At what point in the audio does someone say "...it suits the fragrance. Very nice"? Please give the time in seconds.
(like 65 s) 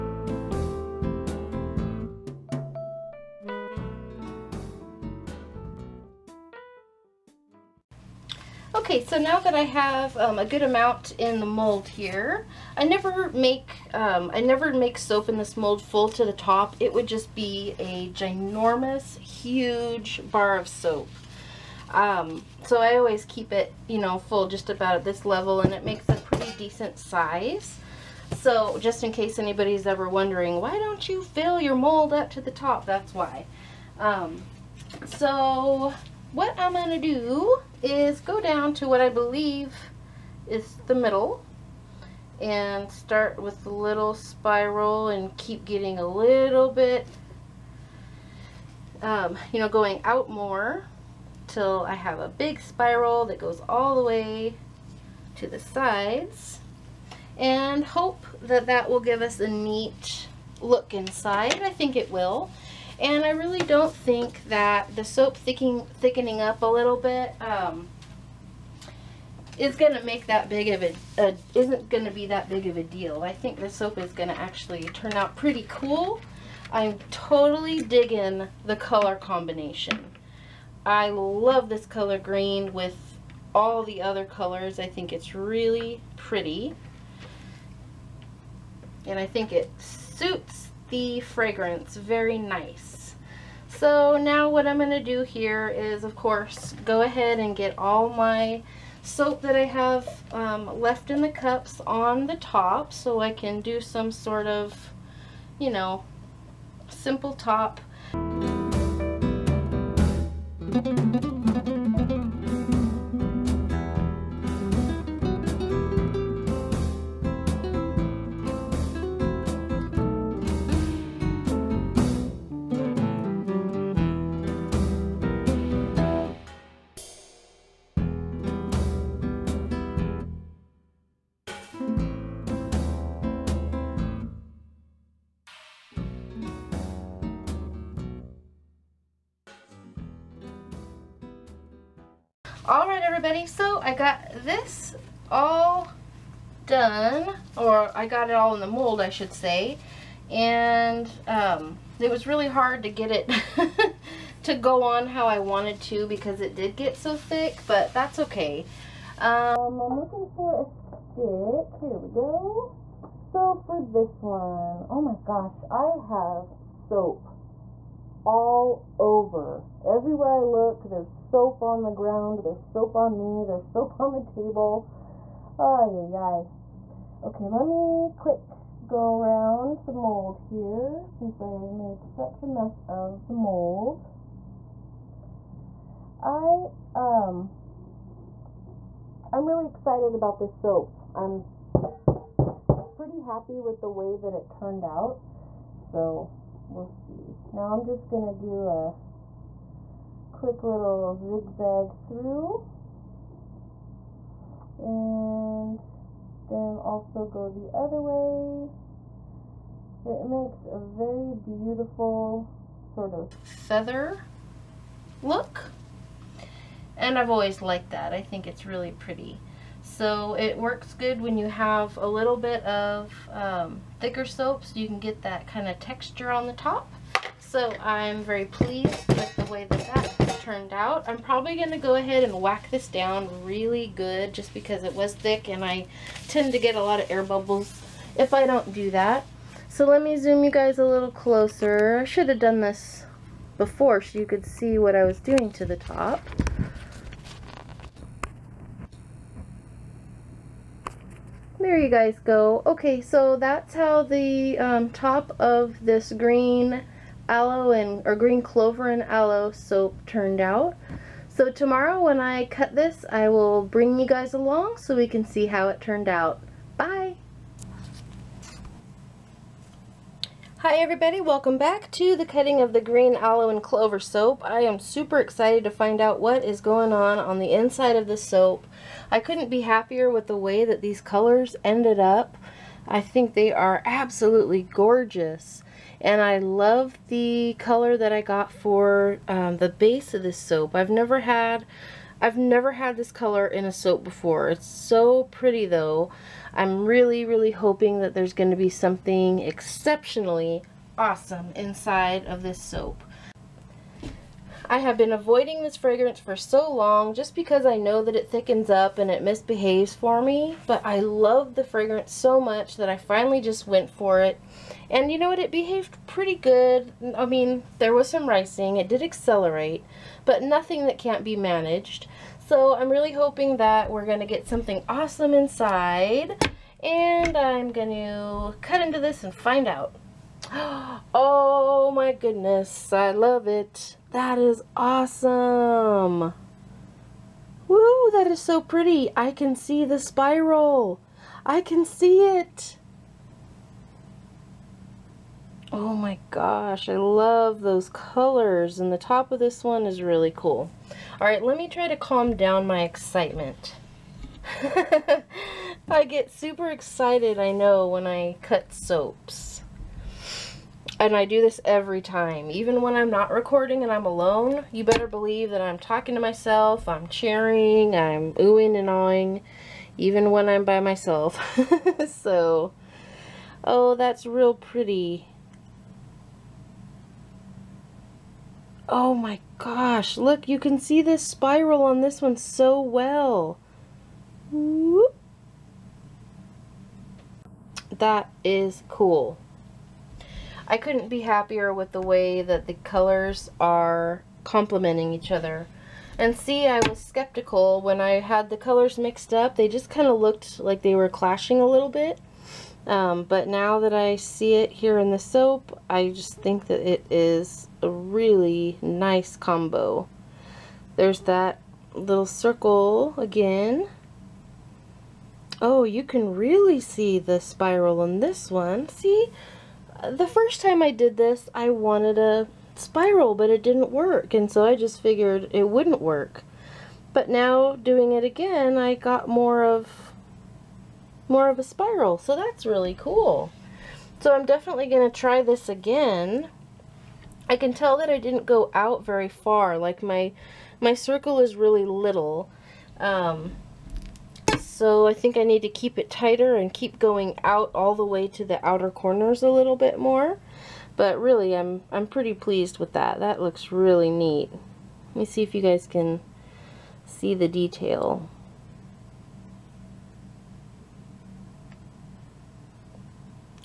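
89 s.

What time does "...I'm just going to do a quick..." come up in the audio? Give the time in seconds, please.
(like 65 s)
197 s.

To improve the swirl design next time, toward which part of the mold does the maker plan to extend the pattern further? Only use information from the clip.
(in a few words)
outer corners.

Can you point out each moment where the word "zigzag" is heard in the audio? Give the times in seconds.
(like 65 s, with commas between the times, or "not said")
201 s.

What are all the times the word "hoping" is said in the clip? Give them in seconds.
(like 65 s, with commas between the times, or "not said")
297 s, 323 s.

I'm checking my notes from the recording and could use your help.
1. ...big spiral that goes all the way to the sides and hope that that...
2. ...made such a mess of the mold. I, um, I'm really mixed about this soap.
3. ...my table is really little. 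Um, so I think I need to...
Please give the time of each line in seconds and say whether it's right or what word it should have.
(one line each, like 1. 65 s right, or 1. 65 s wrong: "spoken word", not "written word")
1. 52 s right
2. 181 s wrong: "excited", not "mixed"
3. 440 s wrong: "circle", not "table".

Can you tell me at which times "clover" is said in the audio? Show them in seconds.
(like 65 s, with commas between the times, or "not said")
258 s, 273 s.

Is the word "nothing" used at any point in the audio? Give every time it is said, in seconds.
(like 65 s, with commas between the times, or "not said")
320 s.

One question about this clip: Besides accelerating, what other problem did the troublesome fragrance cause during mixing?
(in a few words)
ricing.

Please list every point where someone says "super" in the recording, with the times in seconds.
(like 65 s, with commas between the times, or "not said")
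274 s, 356 s.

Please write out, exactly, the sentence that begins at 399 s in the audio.
They just kind of looked like they were clashing a little bit.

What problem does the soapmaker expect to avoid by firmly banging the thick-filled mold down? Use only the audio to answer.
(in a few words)
air bubbles.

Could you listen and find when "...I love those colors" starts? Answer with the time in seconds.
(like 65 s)
346 s.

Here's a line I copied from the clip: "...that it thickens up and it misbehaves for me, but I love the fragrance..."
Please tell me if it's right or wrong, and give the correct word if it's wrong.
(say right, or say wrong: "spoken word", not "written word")
right.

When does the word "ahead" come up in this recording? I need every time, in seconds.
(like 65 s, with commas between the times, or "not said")
97 s, 231 s.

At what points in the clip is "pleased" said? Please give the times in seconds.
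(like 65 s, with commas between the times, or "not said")
228 s, 452 s.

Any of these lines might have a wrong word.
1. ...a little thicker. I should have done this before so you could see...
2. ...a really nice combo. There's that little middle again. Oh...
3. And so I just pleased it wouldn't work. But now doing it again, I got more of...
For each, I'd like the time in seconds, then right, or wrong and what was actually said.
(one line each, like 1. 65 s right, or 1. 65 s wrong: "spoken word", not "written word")
1. 240 s wrong: "closer", not "thicker"
2. 407 s wrong: "circle", not "middle"
3. 424 s wrong: "figured", not "pleased".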